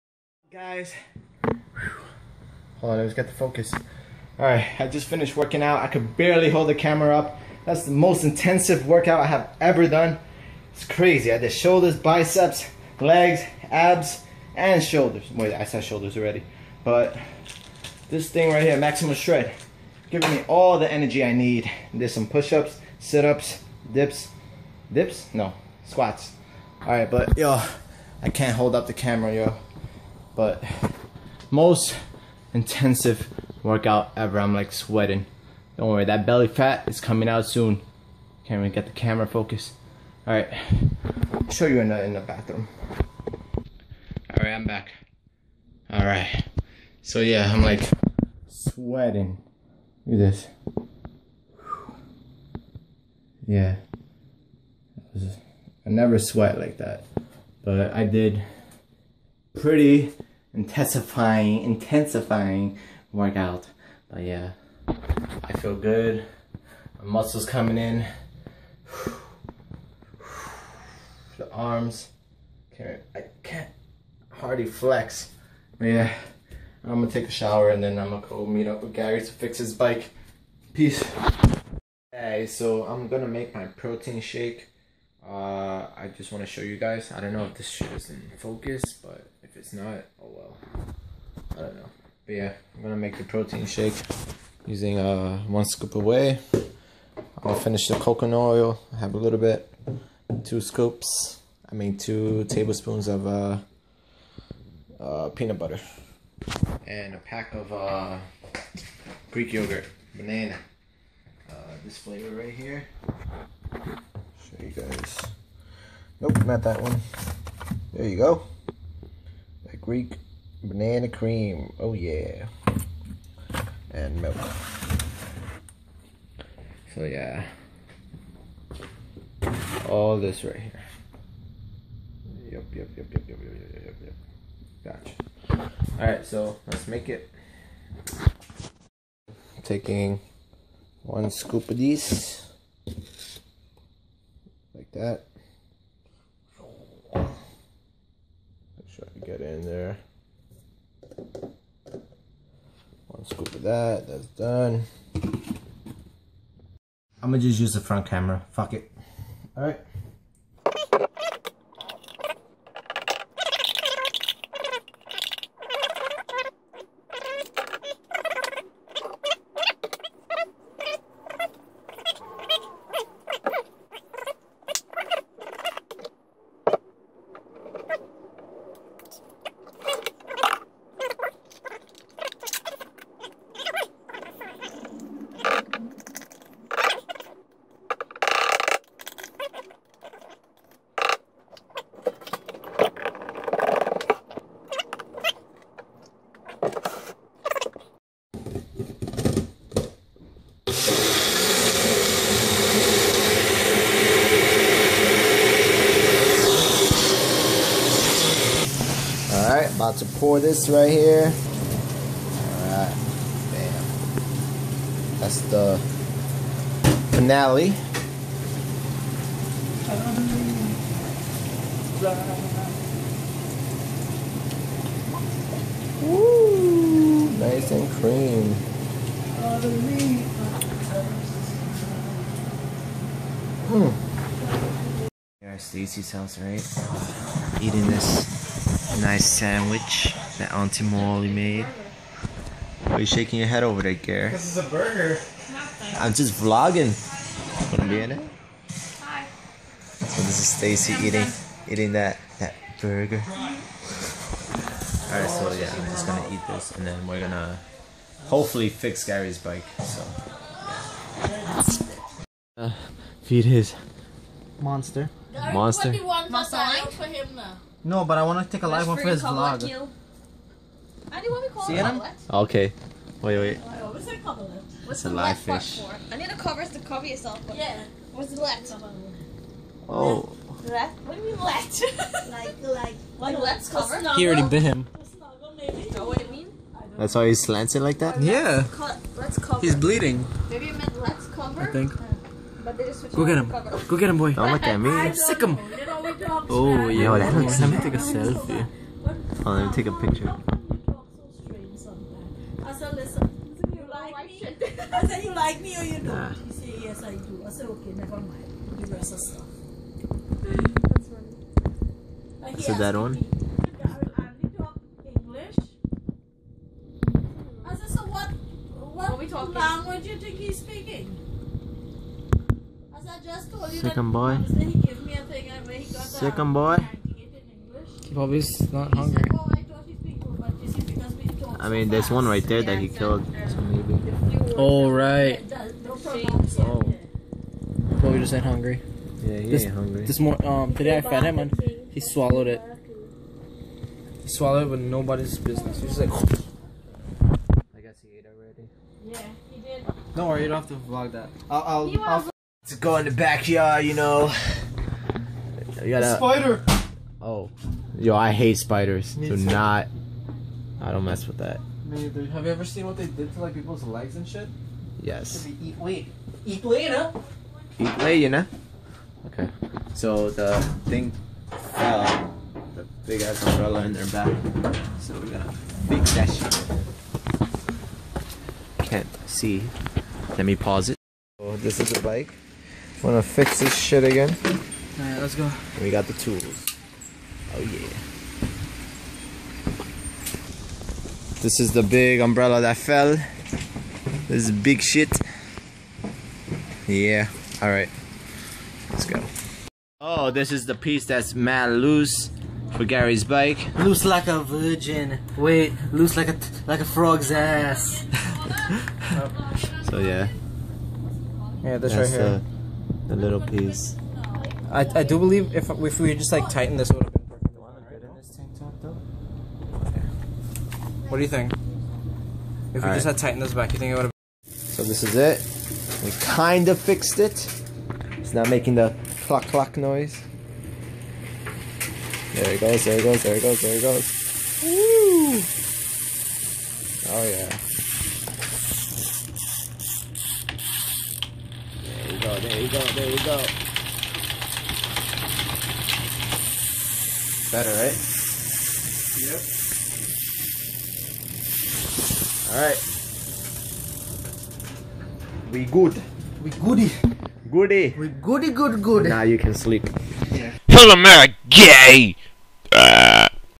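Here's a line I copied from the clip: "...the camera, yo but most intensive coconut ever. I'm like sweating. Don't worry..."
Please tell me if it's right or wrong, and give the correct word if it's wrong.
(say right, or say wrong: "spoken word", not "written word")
wrong: "workout", not "coconut".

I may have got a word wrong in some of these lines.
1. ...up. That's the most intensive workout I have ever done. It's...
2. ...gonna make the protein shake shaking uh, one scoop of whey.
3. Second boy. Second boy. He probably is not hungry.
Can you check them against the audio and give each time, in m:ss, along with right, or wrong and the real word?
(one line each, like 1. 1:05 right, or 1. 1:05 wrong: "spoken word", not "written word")
1. 0:07 right
2. 1:32 wrong: "using", not "shaking"
3. 5:23 right.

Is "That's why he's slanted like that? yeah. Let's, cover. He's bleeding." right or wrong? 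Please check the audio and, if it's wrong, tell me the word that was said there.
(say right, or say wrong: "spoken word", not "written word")
right.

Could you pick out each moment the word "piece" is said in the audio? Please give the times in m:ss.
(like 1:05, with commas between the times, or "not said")
6:40, 6:53.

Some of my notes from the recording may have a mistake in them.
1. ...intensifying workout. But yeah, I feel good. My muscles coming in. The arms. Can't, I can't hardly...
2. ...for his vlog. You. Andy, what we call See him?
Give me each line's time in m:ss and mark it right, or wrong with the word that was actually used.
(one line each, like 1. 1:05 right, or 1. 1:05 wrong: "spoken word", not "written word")
1. 1:01 right
2. 4:28 right.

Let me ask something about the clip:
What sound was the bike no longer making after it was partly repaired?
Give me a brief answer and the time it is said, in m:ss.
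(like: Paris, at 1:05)
Clock clock noise, at 7:09.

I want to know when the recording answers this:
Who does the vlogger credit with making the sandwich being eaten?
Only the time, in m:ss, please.
4:00.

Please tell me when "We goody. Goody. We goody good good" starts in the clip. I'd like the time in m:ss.
7:36.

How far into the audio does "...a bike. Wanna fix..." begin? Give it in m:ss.
6:21.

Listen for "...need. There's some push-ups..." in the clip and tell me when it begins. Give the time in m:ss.
0:21.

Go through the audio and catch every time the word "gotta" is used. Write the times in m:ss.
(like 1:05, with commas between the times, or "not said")
5:55, 6:15.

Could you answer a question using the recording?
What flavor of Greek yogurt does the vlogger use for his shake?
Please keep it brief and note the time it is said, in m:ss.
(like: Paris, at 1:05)
Banana cream, at 2:00.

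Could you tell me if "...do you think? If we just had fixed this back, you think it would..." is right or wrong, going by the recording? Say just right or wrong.
wrong.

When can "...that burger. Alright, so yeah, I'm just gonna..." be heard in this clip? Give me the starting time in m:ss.
4:12.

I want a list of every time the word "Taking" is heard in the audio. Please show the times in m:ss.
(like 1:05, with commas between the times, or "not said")
2:19.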